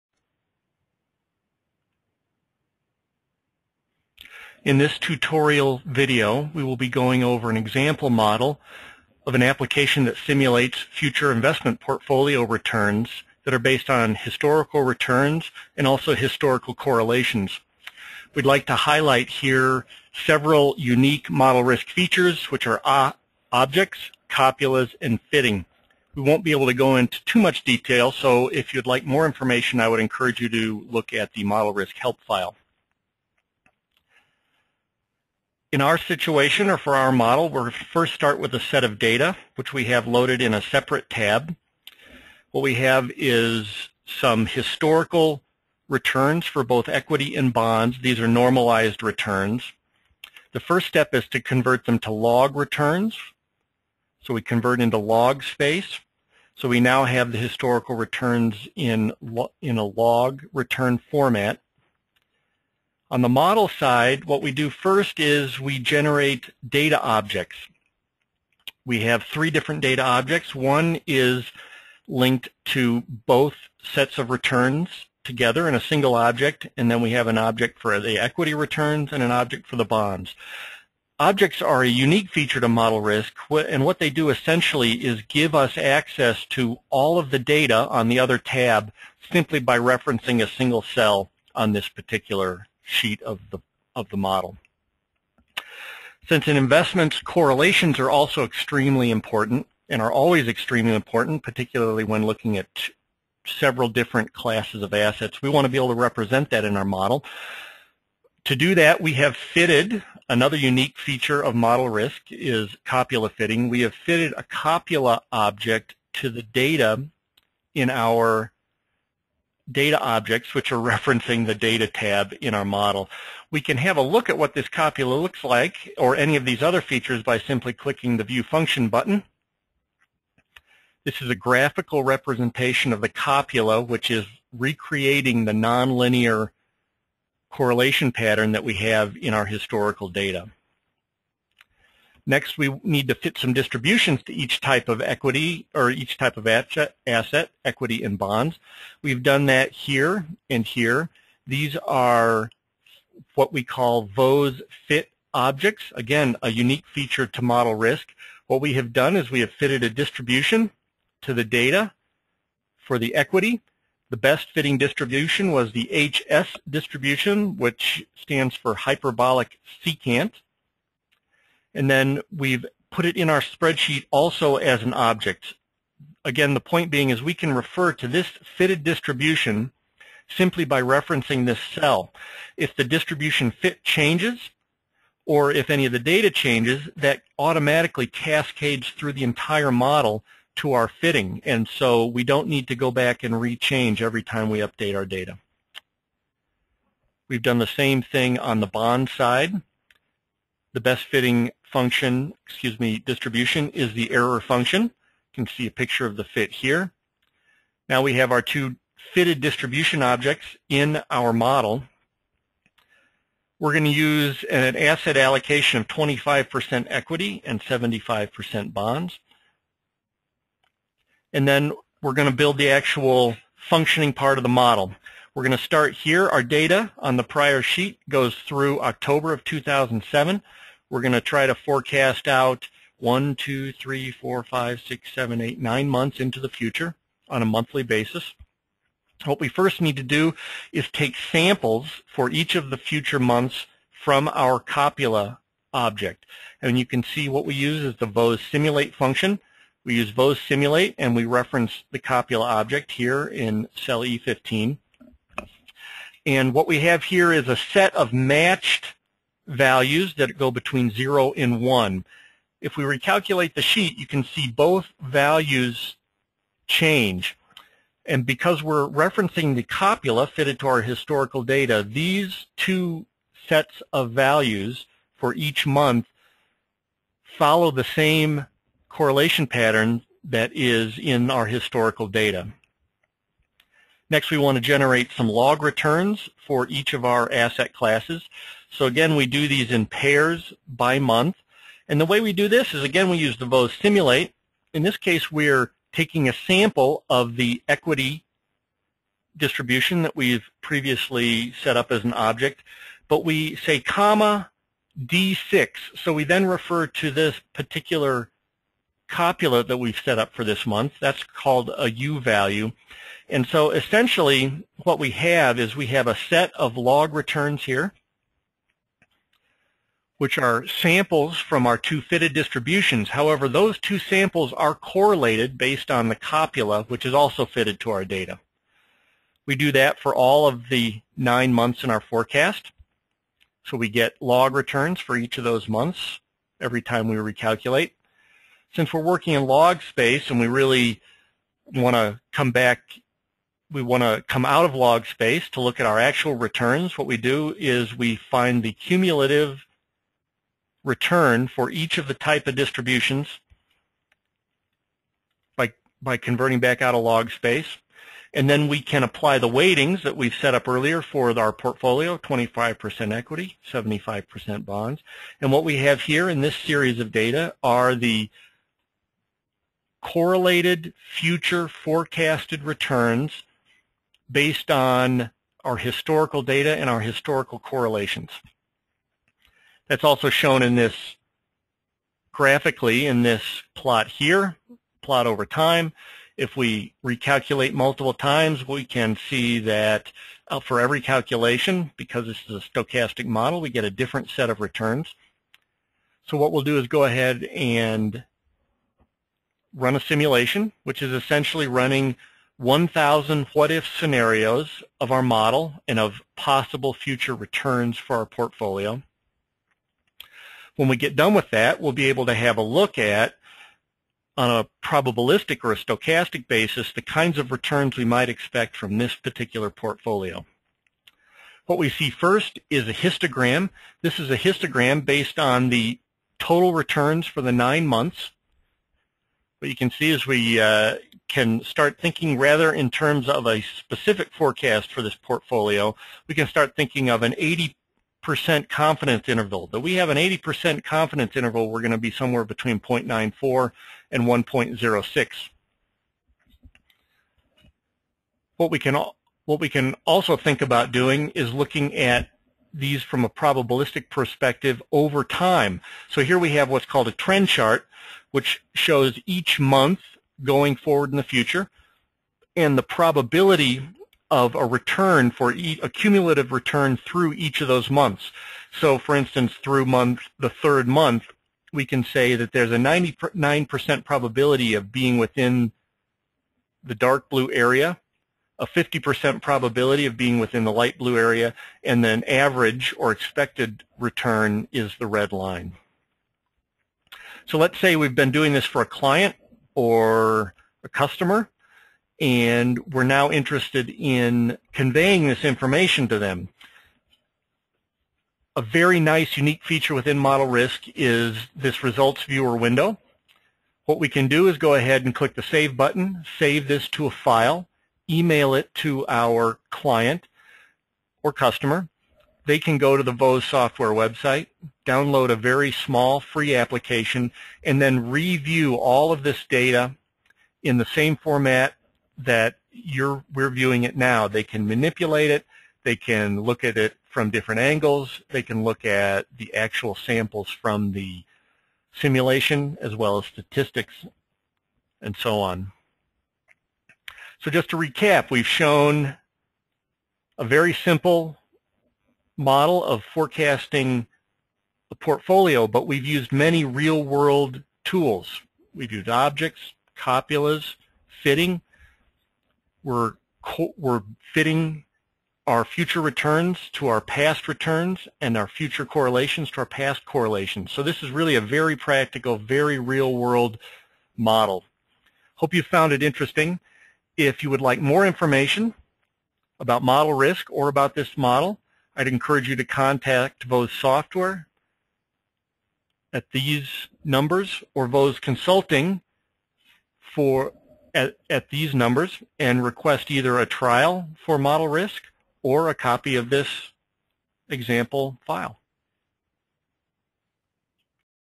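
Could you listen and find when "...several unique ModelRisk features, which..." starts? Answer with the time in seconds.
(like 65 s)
20 s.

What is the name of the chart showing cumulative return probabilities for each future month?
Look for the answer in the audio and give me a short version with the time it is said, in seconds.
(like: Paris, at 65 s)
trend chart, at 457 s.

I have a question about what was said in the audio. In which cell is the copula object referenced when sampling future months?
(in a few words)
E15.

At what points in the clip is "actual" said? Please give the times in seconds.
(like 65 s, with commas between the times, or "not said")
222 s, 345 s, 529 s.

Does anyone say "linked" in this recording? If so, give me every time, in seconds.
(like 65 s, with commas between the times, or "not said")
72 s.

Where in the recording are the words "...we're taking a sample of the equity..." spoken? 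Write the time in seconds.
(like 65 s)
295 s.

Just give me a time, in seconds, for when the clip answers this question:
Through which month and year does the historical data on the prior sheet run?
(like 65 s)
228 s.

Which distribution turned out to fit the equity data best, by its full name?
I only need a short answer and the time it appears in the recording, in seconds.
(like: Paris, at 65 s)
hyperbolic secant, at 168 s.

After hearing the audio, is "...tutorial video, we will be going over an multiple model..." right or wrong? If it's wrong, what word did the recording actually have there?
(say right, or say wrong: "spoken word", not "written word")
wrong: "example", not "multiple".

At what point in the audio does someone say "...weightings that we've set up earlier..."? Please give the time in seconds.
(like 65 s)
359 s.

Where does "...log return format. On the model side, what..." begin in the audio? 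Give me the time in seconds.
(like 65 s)
59 s.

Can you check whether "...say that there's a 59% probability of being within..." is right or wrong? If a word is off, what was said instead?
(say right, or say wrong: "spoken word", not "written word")
wrong: "99", not "59".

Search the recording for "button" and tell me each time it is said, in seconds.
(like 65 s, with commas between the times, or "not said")
128 s, 505 s.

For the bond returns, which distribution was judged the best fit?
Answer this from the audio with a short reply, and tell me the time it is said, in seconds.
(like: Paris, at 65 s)
error function, at 204 s.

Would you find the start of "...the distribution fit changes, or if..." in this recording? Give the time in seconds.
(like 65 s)
182 s.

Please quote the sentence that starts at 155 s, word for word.
Again, a unique feature to ModelRisk.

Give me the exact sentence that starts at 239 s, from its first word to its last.
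What we first need to do is take samples for each of the future months from our copula object.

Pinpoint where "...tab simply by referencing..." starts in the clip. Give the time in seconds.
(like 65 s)
88 s.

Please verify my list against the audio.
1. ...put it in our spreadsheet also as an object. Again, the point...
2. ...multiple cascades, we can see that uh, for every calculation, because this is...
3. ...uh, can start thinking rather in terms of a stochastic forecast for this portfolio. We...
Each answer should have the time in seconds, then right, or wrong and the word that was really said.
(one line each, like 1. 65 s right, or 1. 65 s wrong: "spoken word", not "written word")
1. 172 s right
2. 387 s wrong: "times", not "cascades"
3. 430 s wrong: "specific", not "stochastic".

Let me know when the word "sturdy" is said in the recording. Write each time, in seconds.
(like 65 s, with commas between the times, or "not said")
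not said.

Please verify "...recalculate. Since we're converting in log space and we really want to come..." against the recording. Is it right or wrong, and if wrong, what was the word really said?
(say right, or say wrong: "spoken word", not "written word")
wrong: "working", not "converting".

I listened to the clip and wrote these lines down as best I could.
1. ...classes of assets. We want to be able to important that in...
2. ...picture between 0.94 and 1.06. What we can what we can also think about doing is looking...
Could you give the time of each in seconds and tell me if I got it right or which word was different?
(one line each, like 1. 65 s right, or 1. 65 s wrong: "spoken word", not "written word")
1. 104 s wrong: "represent", not "important"
2. 442 s wrong: "somewhere", not "picture".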